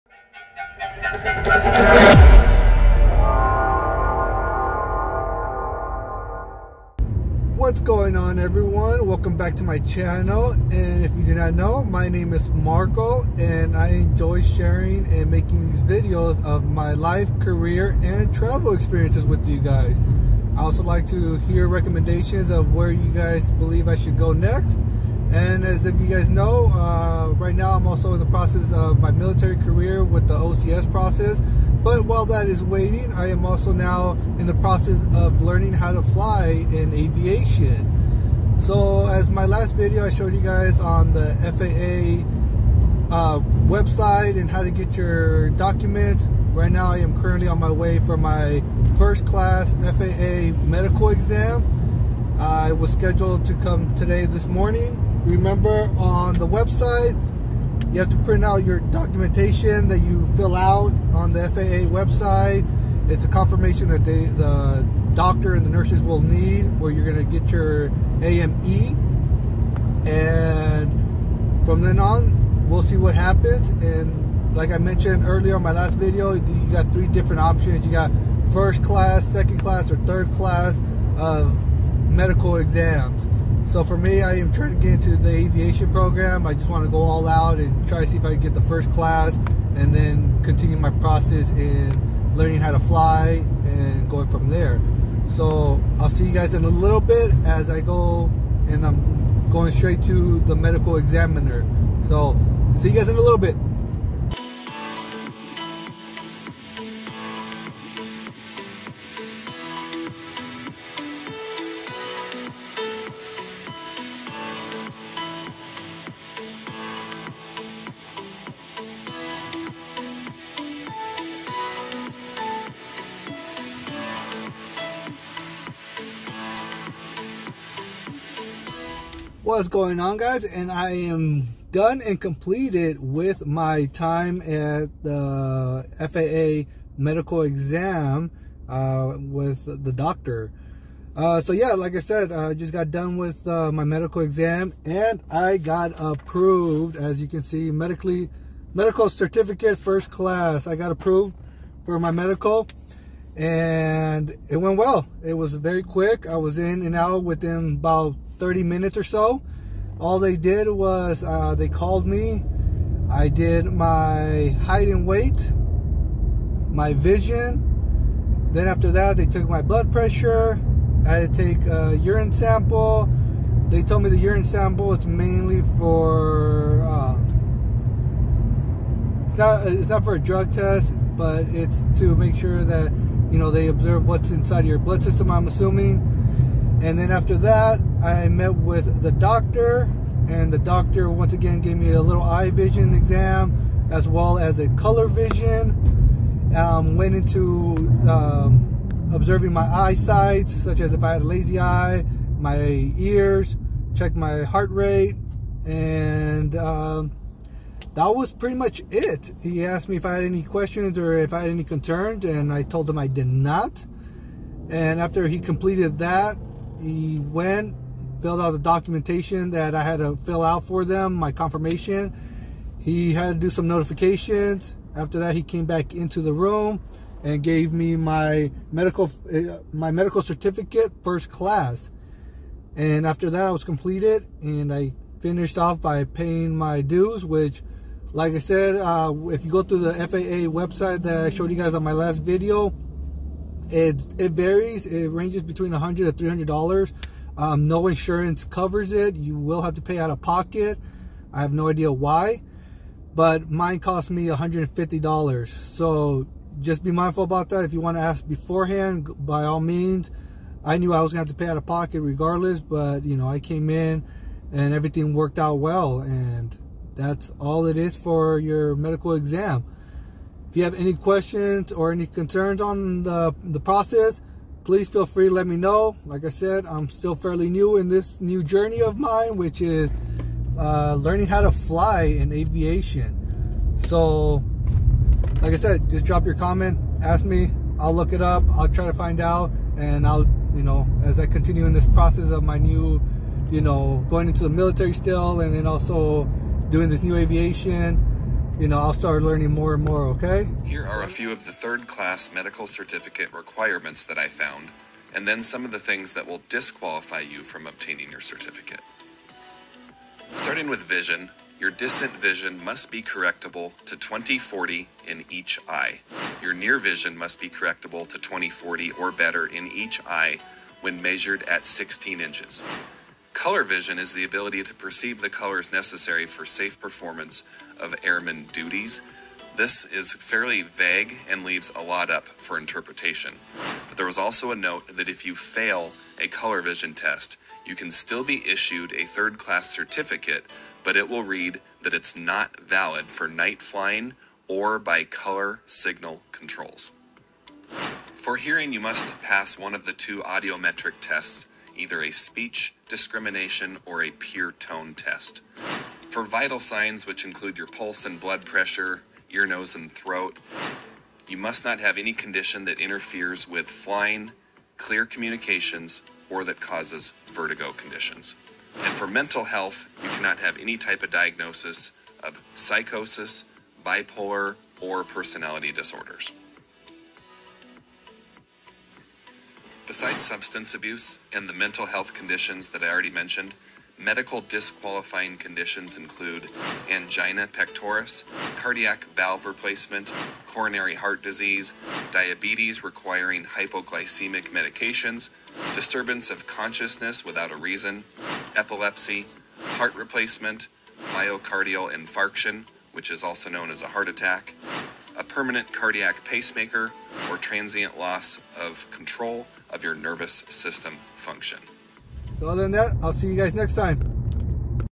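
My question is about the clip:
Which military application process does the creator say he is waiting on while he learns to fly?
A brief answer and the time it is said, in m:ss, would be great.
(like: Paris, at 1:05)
OCS, at 0:30.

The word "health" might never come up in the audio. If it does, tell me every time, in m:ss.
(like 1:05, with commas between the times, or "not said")
6:09, 6:21.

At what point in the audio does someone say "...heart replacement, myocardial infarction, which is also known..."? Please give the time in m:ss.
6:39.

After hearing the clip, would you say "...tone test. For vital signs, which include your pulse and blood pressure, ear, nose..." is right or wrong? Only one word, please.
right.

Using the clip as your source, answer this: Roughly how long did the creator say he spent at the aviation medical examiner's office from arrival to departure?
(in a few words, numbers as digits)
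30 minutes.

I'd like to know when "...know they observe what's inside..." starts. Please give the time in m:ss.
3:03.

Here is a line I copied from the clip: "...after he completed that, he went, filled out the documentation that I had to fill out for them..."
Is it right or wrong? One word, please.
right.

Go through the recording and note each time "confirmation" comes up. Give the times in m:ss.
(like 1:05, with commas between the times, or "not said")
1:03, 3:41.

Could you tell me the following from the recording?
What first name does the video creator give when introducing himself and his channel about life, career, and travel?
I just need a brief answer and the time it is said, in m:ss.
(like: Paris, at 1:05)
Marco, at 0:12.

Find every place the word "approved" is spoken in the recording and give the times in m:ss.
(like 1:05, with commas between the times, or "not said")
2:25, 2:30.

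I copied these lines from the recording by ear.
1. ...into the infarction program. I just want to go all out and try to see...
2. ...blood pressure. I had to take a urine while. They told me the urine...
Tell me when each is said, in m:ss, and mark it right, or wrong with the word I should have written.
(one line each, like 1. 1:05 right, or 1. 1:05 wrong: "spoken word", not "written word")
1. 1:24 wrong: "aviation", not "infarction"
2. 2:49 wrong: "sample", not "while".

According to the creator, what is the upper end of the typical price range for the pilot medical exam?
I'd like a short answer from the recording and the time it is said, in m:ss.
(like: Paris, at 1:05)
$300, at 4:06.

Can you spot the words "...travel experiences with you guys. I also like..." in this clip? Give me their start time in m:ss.
0:18.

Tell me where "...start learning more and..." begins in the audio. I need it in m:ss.
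4:58.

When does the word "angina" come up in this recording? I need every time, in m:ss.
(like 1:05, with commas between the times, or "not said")
6:26.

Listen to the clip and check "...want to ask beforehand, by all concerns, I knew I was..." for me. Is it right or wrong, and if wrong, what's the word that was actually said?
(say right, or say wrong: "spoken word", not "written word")
wrong: "means", not "concerns".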